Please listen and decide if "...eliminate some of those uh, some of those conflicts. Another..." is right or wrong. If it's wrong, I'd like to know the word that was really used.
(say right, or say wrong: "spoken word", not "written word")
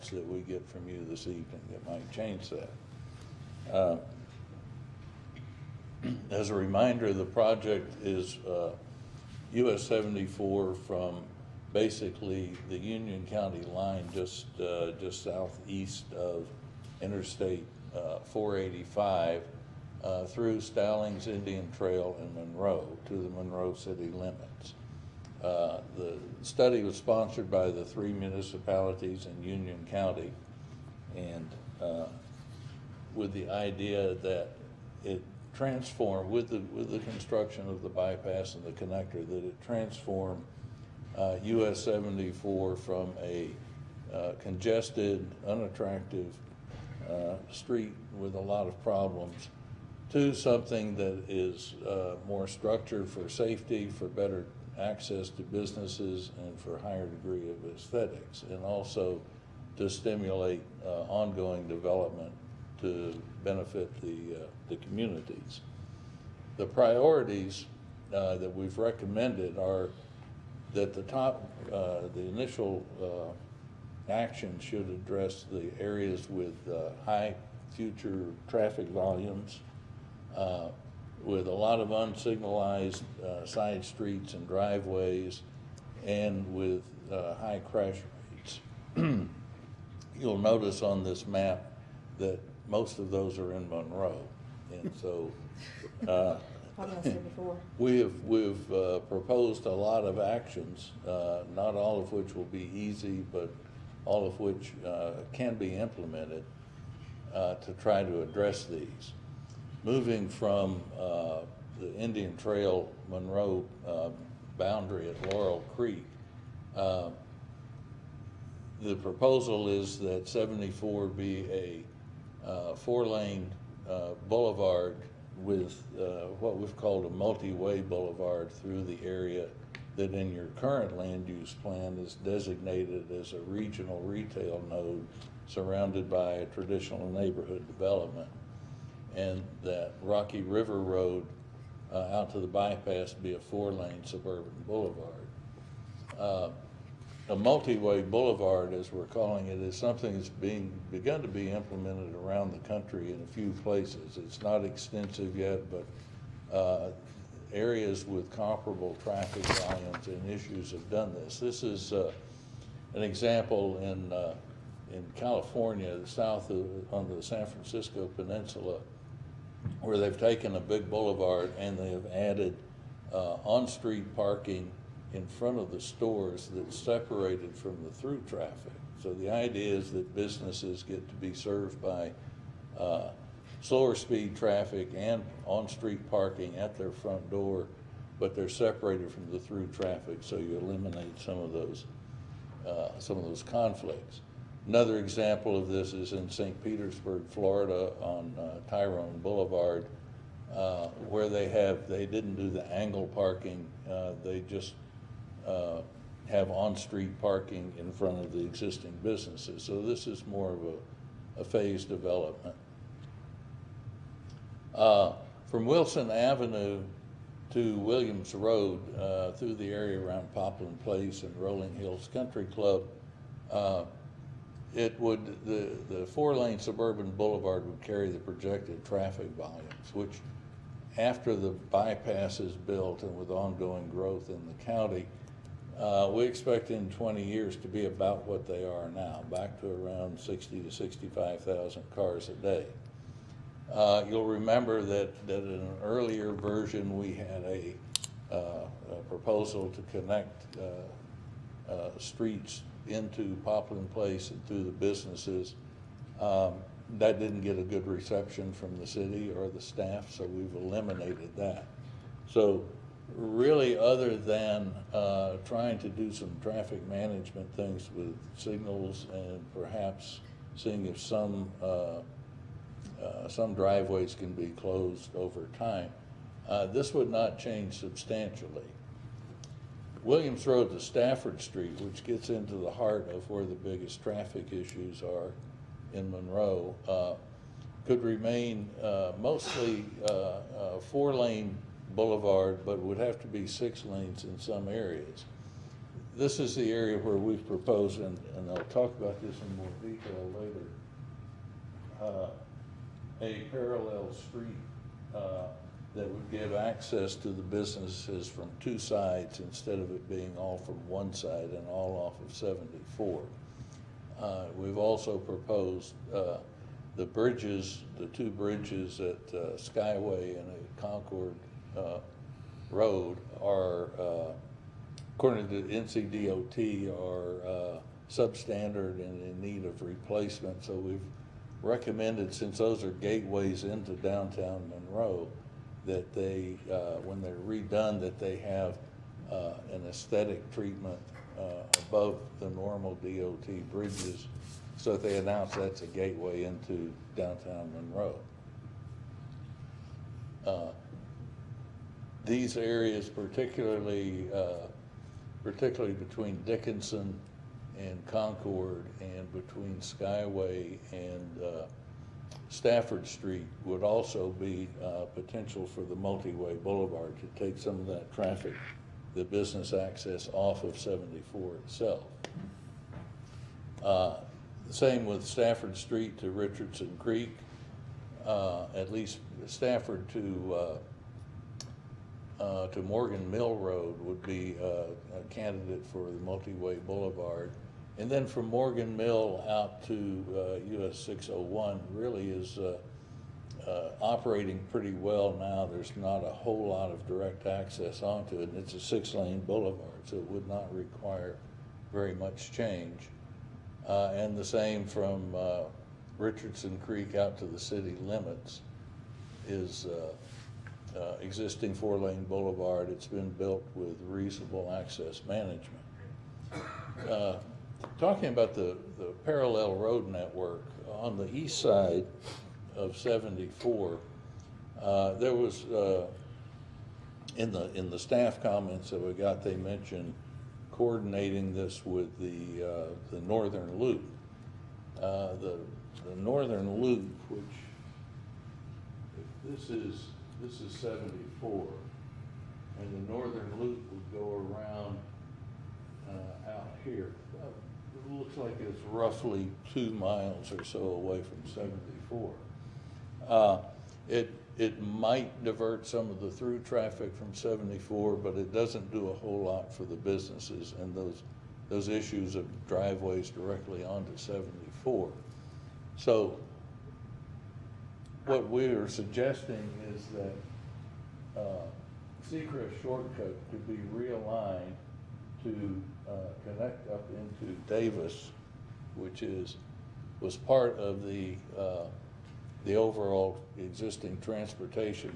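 right.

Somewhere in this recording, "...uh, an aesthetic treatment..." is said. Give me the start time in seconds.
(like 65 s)
339 s.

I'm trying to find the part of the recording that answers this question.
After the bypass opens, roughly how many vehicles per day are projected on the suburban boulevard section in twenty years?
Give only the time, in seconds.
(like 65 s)
240 s.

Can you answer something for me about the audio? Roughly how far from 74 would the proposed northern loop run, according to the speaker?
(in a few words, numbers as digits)
two miles.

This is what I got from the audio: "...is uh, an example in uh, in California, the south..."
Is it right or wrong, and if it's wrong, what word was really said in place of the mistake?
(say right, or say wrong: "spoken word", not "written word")
right.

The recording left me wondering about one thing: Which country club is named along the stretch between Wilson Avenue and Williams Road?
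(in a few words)
Rolling Hills Country Club.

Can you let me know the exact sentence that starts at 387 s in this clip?
And then from Morgan Mill out to uh, US 601 really is uh, uh, operating pretty well now.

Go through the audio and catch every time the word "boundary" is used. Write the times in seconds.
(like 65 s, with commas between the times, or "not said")
114 s.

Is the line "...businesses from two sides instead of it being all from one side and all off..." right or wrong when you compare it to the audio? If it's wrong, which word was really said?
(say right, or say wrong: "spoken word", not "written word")
right.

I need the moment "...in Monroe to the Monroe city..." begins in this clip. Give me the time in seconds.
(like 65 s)
22 s.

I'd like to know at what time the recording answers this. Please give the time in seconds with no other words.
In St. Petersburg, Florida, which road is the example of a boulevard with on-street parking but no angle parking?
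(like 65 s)
198 s.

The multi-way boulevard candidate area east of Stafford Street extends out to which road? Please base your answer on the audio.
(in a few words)
Morgan Mill Road.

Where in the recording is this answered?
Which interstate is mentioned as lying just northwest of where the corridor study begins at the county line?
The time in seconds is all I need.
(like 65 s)
17 s.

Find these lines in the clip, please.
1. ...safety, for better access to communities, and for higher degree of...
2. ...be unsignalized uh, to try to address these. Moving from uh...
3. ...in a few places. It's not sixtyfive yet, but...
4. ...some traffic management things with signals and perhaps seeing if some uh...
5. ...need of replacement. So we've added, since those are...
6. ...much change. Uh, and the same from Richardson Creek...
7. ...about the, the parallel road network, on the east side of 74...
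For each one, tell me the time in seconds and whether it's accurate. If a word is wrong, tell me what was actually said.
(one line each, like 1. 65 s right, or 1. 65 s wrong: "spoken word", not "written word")
1. 53 s wrong: "businesses", not "communities"
2. 105 s wrong: "implemented", not "unsignalized"
3. 153 s wrong: "extensive", not "sixtyfive"
4. 266 s right
5. 329 s wrong: "recommended", not "added"
6. 402 s right
7. 418 s right.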